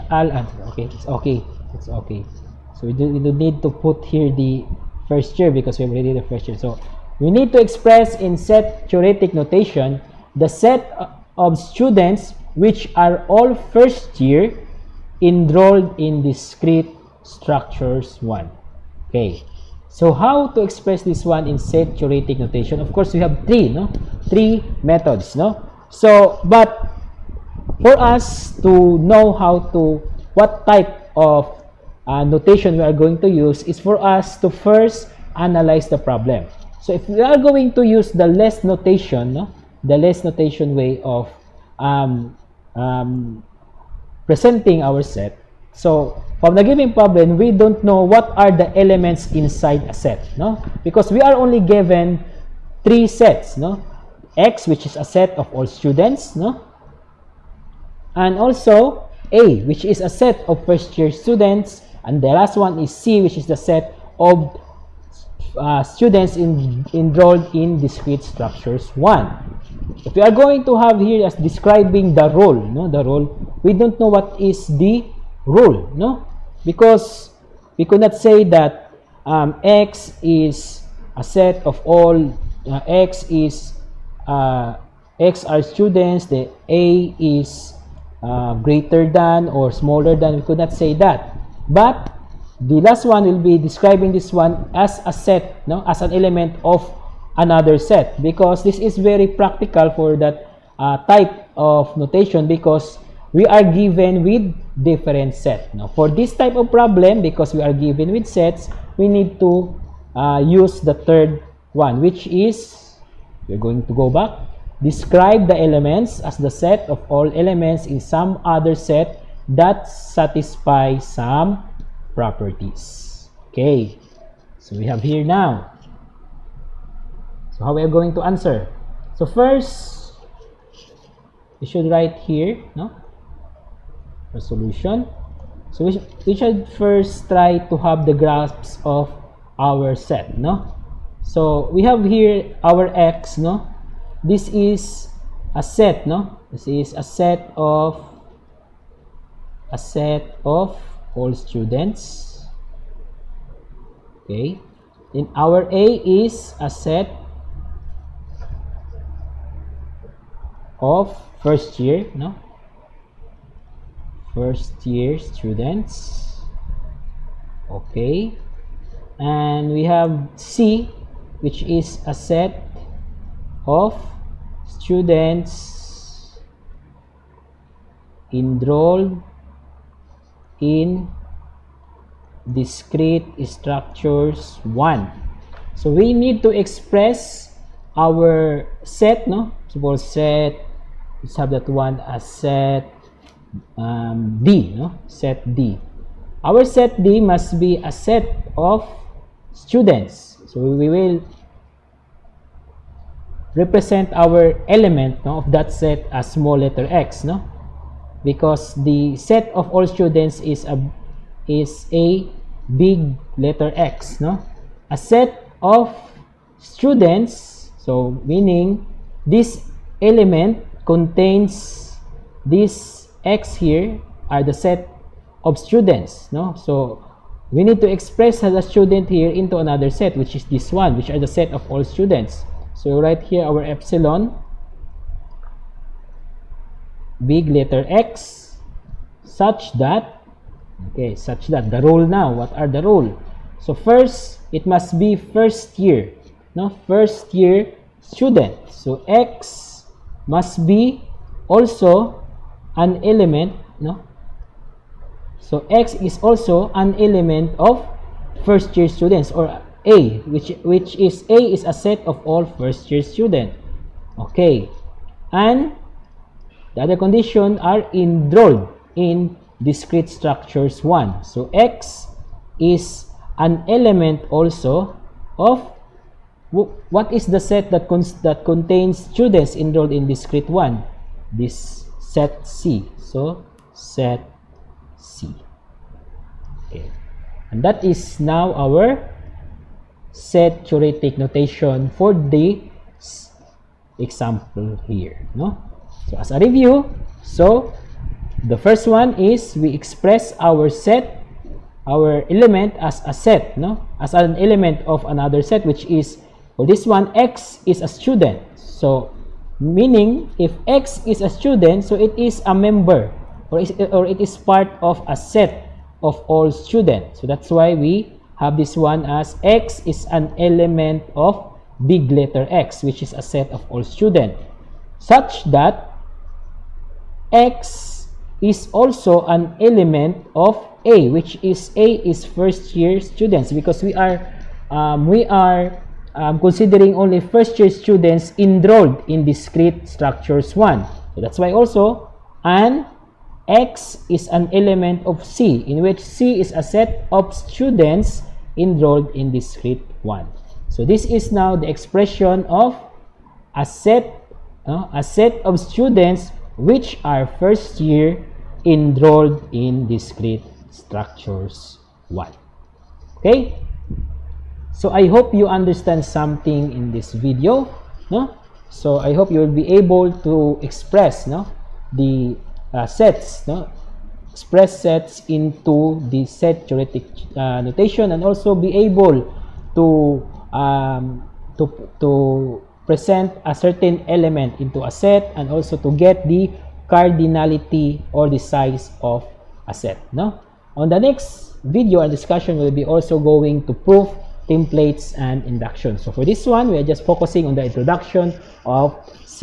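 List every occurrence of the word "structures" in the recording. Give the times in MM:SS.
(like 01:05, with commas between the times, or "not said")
00:17, 01:08, 03:03, 04:30, 05:39, 06:00.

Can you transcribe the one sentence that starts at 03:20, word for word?
So we will represent our element no, of that set as small letter x, no?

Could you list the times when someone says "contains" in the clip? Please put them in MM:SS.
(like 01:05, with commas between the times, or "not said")
03:40, 04:38.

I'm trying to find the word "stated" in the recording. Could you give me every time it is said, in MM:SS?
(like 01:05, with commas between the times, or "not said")
not said.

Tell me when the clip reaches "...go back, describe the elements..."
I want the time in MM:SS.
01:53.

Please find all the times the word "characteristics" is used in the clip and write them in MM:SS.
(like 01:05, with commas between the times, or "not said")
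not said.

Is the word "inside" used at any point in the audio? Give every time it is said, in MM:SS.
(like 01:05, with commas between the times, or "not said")
00:49.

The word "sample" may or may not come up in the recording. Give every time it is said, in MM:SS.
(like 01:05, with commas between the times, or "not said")
not said.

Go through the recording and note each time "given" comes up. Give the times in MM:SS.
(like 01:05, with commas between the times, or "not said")
00:46, 00:51, 01:43, 01:47.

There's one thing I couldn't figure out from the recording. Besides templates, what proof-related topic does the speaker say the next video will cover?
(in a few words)
induction.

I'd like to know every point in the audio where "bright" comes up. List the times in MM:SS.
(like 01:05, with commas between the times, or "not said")
not said.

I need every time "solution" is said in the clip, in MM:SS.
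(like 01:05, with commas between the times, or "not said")
02:14.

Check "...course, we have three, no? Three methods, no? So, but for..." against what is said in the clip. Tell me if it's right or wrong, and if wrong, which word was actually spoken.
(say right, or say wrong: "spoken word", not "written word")
right.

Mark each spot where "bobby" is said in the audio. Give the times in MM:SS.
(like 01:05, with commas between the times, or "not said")
not said.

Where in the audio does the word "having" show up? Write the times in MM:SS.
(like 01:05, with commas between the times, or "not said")
not said.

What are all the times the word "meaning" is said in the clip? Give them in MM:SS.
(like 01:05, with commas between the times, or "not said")
03:38, 05:09.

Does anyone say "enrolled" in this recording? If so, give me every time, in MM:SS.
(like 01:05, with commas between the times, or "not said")
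00:15, 01:06, 02:58, 04:27, 04:39, 05:38, 05:48, 05:58.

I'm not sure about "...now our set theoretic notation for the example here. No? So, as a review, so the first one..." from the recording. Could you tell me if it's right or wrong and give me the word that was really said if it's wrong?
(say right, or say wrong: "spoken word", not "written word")
right.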